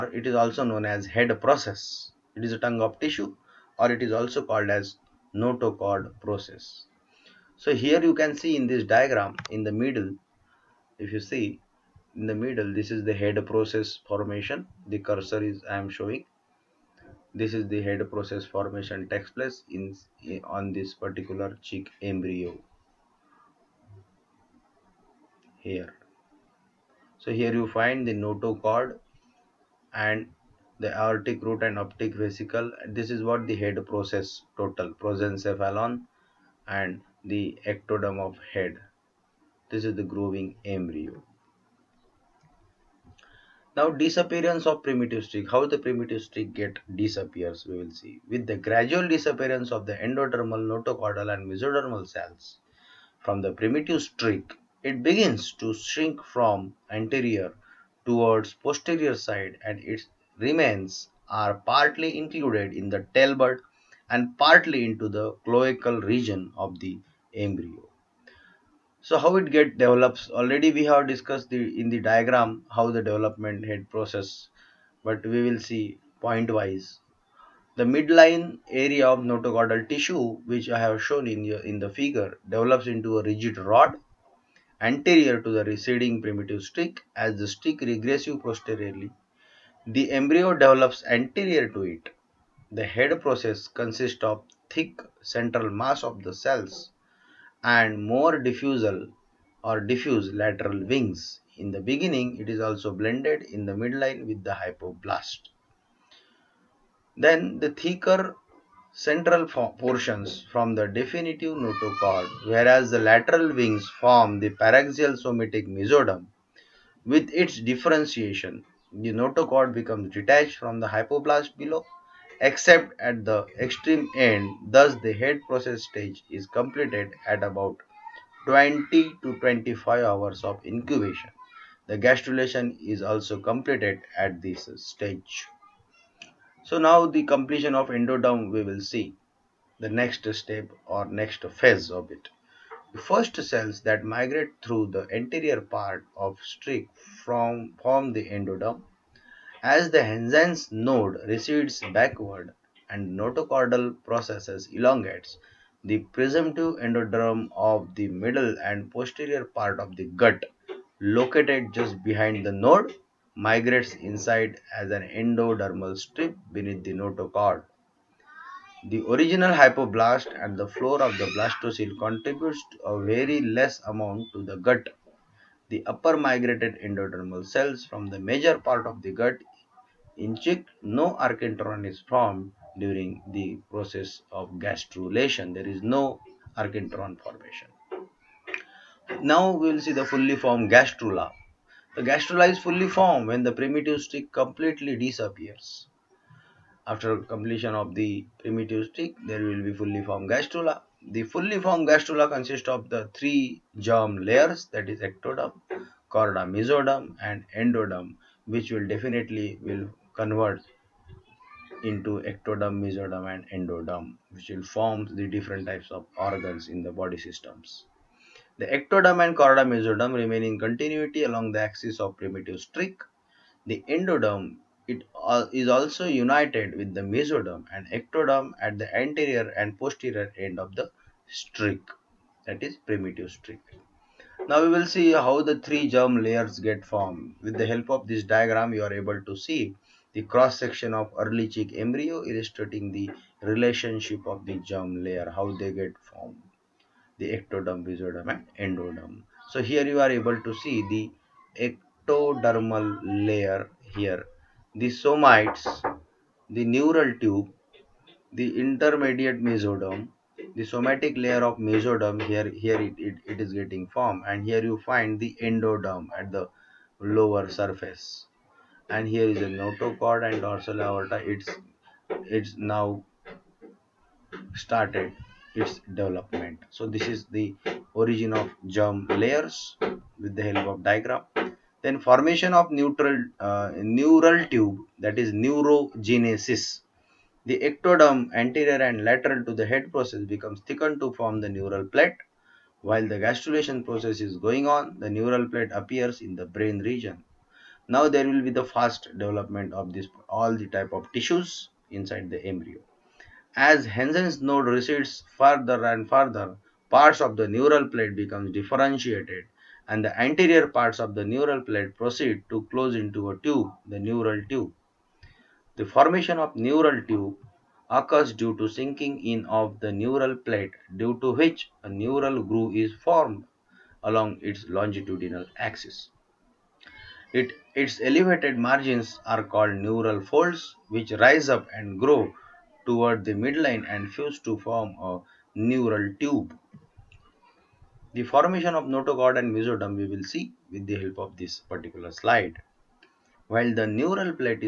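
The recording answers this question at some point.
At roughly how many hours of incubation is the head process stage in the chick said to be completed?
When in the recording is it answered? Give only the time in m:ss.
2:08.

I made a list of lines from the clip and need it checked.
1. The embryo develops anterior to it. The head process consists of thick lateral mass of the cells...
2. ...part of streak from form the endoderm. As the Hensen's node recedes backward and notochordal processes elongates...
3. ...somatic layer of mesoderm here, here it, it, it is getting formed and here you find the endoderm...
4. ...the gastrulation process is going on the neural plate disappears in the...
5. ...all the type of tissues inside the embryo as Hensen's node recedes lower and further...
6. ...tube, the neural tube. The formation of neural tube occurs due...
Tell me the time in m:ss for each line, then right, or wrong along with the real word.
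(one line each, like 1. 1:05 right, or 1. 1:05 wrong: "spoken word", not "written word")
1. 1:29 wrong: "central", not "lateral"
2. 2:25 right
3. 4:20 right
4. 4:53 wrong: "appears", not "disappears"
5. 5:00 wrong: "further", not "lower"
6. 5:13 right.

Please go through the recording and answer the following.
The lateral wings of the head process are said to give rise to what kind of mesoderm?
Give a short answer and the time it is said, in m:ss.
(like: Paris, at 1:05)
Paraxial somatic mesoderm, at 1:54.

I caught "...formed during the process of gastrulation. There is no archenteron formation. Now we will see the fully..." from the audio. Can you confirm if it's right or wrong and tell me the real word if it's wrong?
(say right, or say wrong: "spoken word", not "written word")
right.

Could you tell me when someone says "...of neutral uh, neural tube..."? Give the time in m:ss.
4:42.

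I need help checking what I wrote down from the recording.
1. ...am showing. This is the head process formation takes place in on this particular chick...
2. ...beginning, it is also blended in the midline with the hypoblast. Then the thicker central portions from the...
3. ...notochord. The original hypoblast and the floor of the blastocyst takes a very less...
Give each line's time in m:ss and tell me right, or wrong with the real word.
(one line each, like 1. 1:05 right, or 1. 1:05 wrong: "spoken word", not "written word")
1. 0:15 right
2. 1:41 right
3. 2:46 wrong: "contributes", not "takes".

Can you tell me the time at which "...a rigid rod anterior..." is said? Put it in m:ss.
1:23.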